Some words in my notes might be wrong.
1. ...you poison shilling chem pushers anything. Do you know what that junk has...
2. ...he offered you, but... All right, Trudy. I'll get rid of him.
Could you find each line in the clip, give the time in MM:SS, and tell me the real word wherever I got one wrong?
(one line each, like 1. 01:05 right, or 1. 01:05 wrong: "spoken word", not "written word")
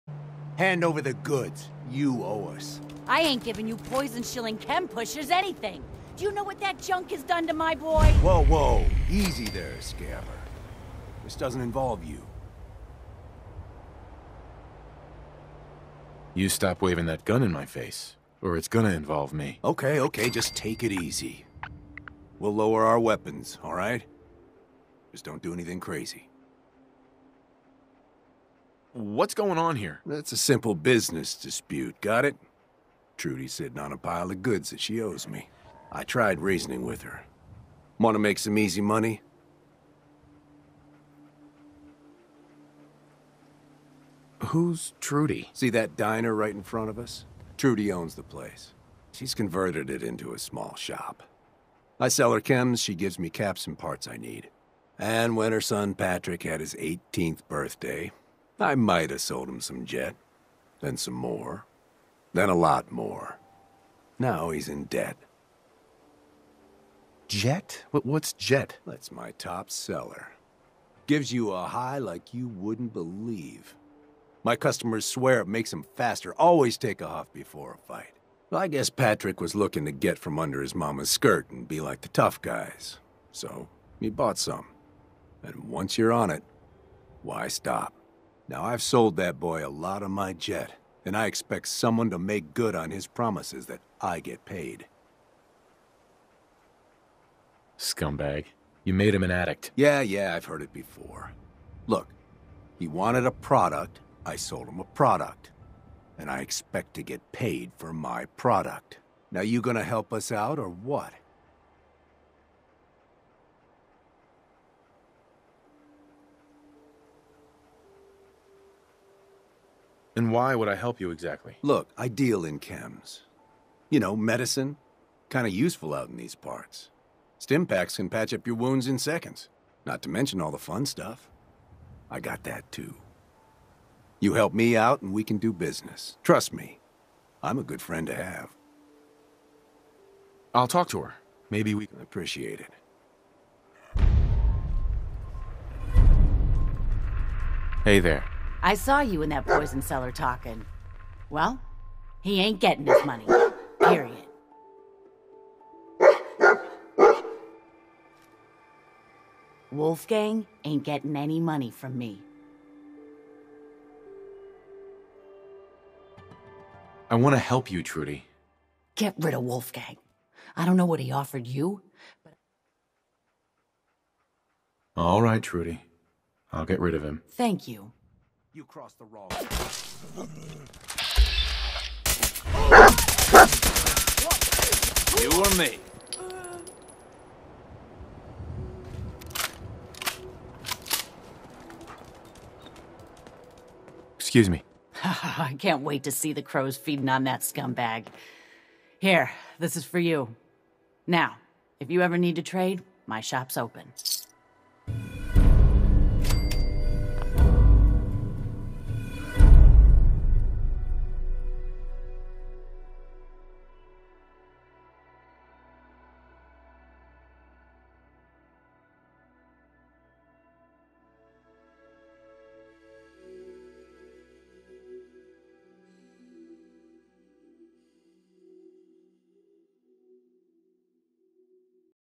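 1. 00:03 right
2. 02:50 right.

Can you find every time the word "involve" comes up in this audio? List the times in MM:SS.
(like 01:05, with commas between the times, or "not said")
00:11, 00:18.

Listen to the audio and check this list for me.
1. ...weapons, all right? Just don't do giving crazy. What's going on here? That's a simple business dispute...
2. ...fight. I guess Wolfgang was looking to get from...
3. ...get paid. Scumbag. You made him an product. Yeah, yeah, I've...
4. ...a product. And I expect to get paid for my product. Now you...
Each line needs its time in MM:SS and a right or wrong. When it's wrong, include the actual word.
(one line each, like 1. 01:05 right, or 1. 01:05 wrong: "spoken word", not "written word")
1. 00:22 wrong: "anything", not "giving"
2. 01:17 wrong: "Patrick", not "Wolfgang"
3. 01:34 wrong: "addict", not "product"
4. 01:44 right.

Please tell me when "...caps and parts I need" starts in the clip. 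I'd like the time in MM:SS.
00:53.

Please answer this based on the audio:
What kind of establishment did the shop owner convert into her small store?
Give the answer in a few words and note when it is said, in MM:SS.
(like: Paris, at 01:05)
diner, at 00:45.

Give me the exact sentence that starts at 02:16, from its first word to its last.
Trust me, I'm a good friend to have.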